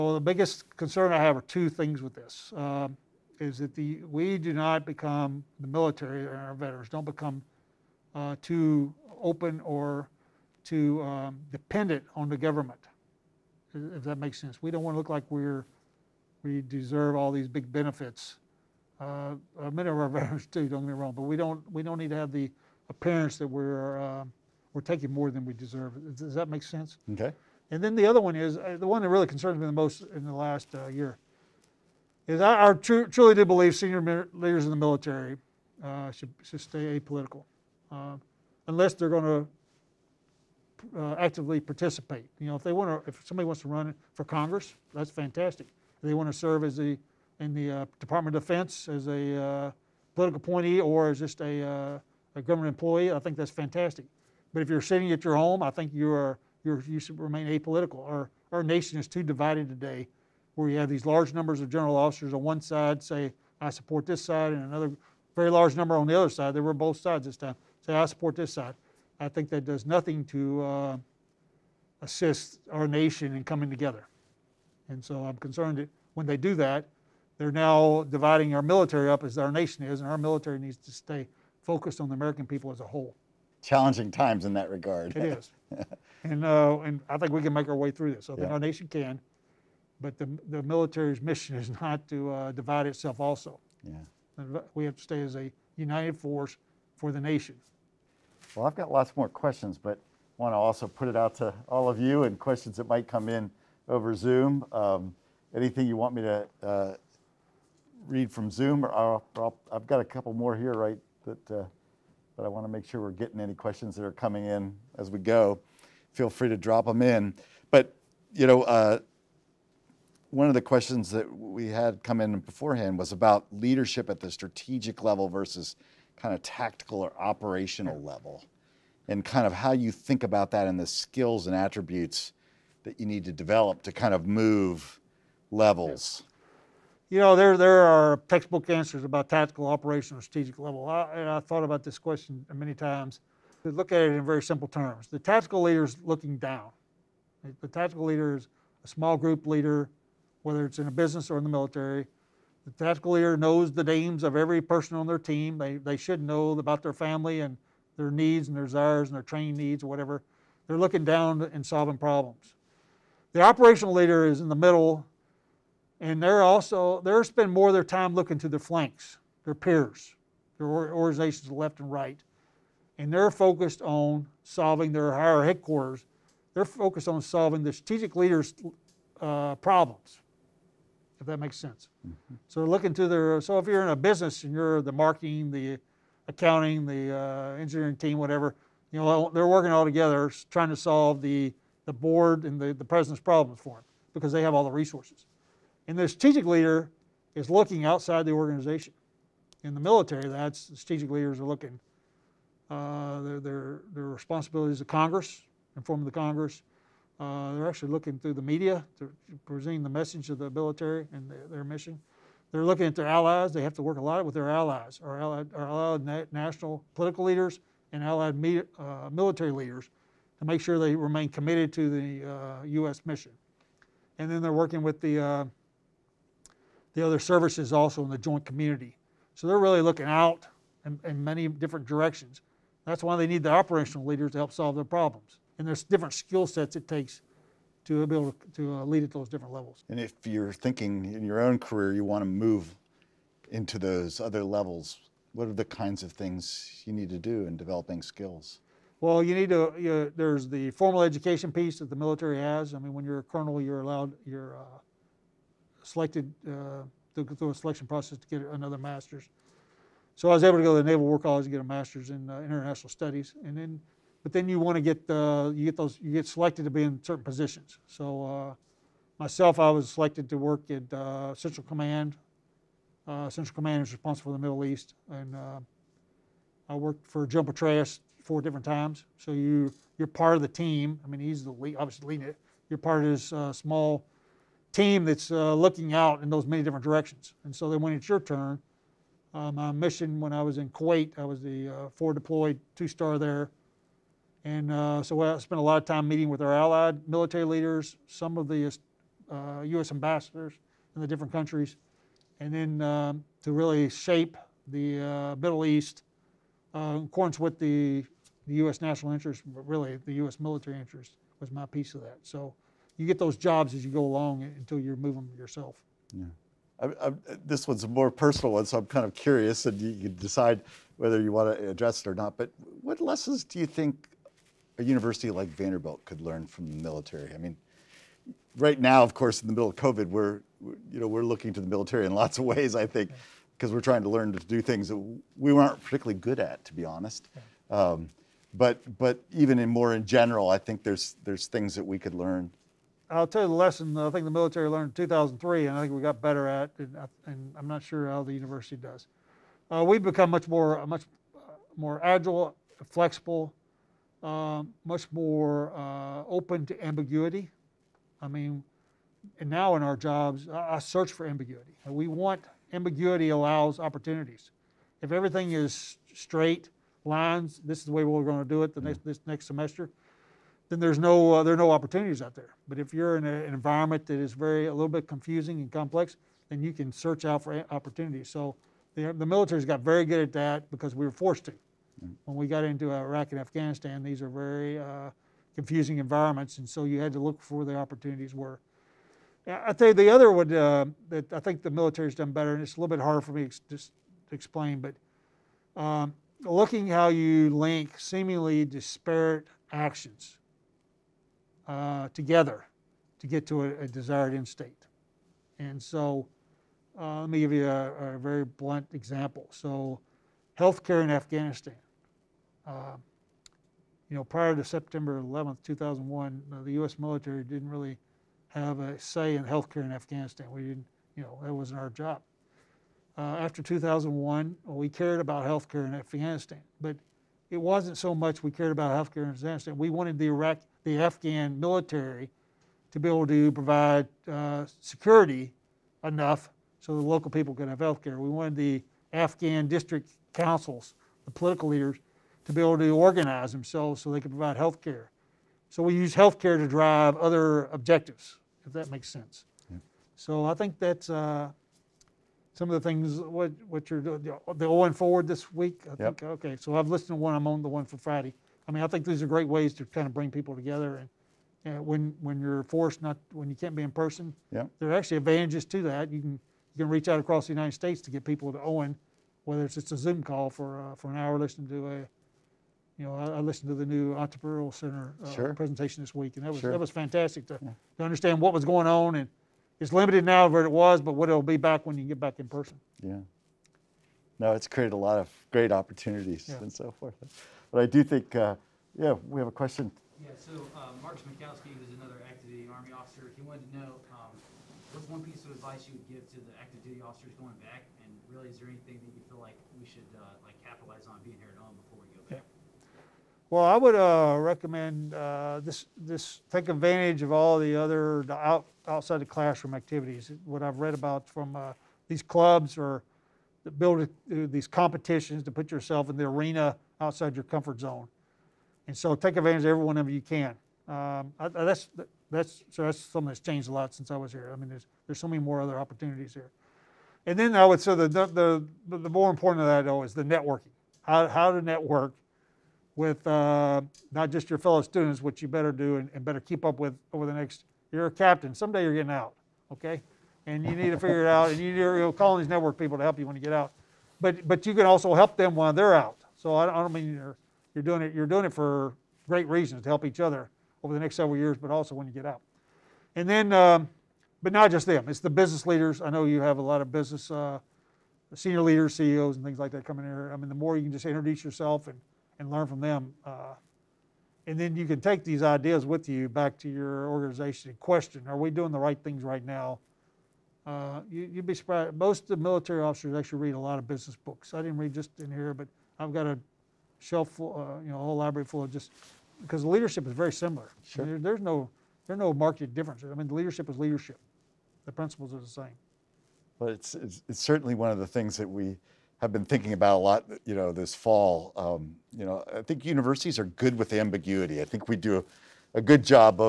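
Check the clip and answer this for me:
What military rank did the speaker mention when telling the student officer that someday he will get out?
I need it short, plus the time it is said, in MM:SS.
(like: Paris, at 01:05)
captain, at 08:58.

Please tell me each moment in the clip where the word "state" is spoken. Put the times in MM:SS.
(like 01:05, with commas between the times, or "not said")
06:44, 07:47.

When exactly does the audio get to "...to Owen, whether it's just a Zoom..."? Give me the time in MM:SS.
07:48.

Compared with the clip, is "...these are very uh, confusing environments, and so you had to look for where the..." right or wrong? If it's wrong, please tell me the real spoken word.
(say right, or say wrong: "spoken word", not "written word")
right.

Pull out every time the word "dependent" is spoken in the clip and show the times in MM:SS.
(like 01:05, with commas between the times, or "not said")
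00:11.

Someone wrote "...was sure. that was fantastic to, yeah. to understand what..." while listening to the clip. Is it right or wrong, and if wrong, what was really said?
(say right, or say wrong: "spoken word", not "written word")
right.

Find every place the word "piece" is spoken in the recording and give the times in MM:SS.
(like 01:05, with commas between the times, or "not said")
04:11, 05:11, 08:15.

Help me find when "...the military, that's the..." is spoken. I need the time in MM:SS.
03:19.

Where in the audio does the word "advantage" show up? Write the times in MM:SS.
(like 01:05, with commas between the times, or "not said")
07:45, 08:26, 08:39.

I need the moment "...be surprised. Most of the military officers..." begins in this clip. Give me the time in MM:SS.
09:31.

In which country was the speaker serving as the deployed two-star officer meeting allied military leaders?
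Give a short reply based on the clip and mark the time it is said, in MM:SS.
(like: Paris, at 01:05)
Kuwait, at 04:50.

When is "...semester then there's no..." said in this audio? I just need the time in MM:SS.
06:09.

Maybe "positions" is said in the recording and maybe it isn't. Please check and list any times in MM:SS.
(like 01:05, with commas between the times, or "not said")
04:27.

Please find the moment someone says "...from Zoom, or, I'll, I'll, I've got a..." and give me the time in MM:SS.
01:48.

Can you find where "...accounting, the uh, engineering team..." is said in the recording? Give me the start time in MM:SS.
03:06.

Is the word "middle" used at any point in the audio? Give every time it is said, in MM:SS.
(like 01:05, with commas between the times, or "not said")
02:44, 04:34, 05:05, 05:29.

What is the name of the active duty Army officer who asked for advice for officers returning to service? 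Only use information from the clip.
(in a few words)
Mark Smikowski.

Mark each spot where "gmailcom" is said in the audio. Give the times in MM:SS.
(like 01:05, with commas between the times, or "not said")
not said.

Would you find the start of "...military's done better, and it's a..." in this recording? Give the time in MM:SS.
06:31.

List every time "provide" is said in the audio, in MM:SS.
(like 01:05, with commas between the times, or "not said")
07:13, 07:24.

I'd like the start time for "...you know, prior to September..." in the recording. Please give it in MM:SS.
06:54.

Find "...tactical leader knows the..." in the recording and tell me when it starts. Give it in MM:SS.
02:32.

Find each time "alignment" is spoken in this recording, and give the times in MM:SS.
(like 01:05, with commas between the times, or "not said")
not said.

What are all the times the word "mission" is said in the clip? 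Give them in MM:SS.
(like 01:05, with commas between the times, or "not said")
01:31, 03:31, 03:43, 04:49.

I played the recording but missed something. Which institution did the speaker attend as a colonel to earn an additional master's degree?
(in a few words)
Naval War College.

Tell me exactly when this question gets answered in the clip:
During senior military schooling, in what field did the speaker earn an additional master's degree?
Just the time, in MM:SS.
04:22.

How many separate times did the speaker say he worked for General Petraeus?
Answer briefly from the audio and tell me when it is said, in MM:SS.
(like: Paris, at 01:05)
4, at 04:38.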